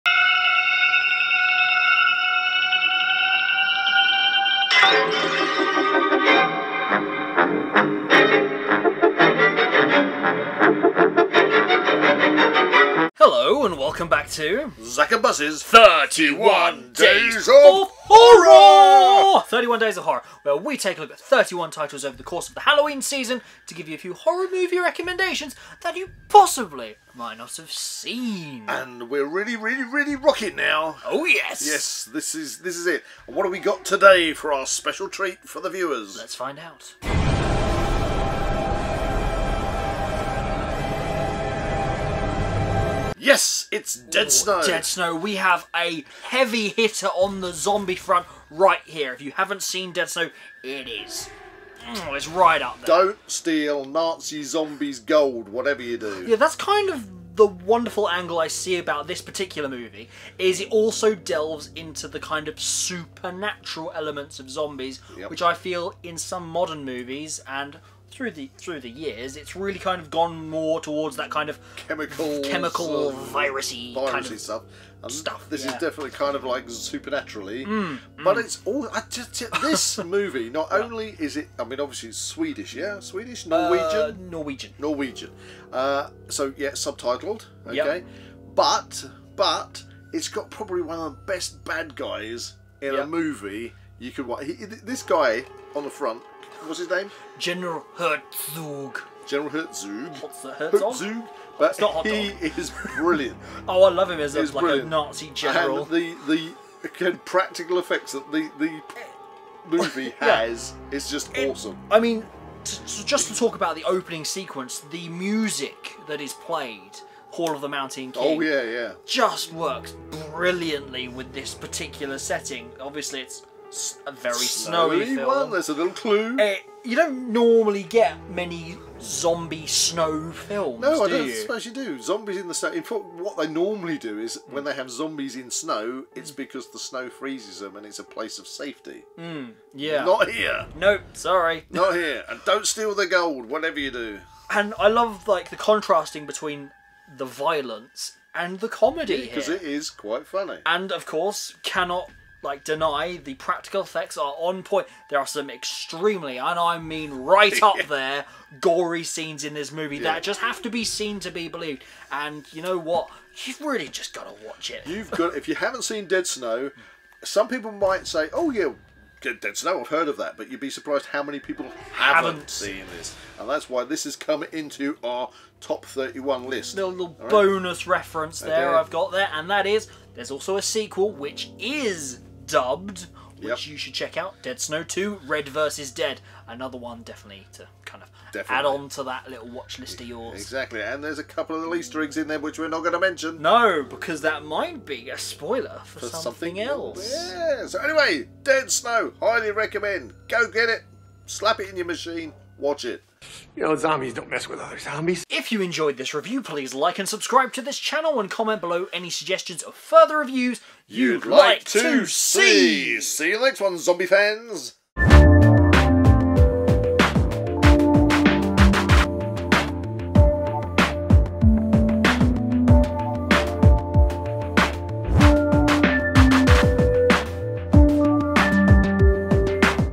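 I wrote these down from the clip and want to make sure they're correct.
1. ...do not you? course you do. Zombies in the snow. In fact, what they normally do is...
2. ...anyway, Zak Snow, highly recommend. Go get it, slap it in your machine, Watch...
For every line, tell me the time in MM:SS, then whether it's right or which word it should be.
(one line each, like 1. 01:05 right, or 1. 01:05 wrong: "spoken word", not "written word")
1. 02:11 wrong: "suppose", not "course"
2. 03:17 wrong: "Dead", not "Zak".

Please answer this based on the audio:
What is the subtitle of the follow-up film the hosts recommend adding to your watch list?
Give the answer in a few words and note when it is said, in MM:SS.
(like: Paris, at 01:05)
Red versus Dead, at 03:05.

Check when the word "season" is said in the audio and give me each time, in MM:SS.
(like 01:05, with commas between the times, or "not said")
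00:23.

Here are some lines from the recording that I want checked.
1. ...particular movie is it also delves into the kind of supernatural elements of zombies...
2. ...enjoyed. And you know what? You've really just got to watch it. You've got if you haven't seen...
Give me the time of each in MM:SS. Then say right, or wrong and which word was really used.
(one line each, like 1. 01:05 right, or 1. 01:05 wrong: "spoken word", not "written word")
1. 00:59 right
2. 02:41 wrong: "believed", not "enjoyed".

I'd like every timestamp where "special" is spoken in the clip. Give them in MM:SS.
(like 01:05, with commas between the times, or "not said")
00:34.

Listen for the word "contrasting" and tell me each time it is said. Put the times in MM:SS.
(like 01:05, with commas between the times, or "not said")
02:25.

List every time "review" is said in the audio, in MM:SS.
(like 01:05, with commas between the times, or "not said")
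03:26, 03:30.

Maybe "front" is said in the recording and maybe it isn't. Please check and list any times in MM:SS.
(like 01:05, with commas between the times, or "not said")
00:47, 01:35.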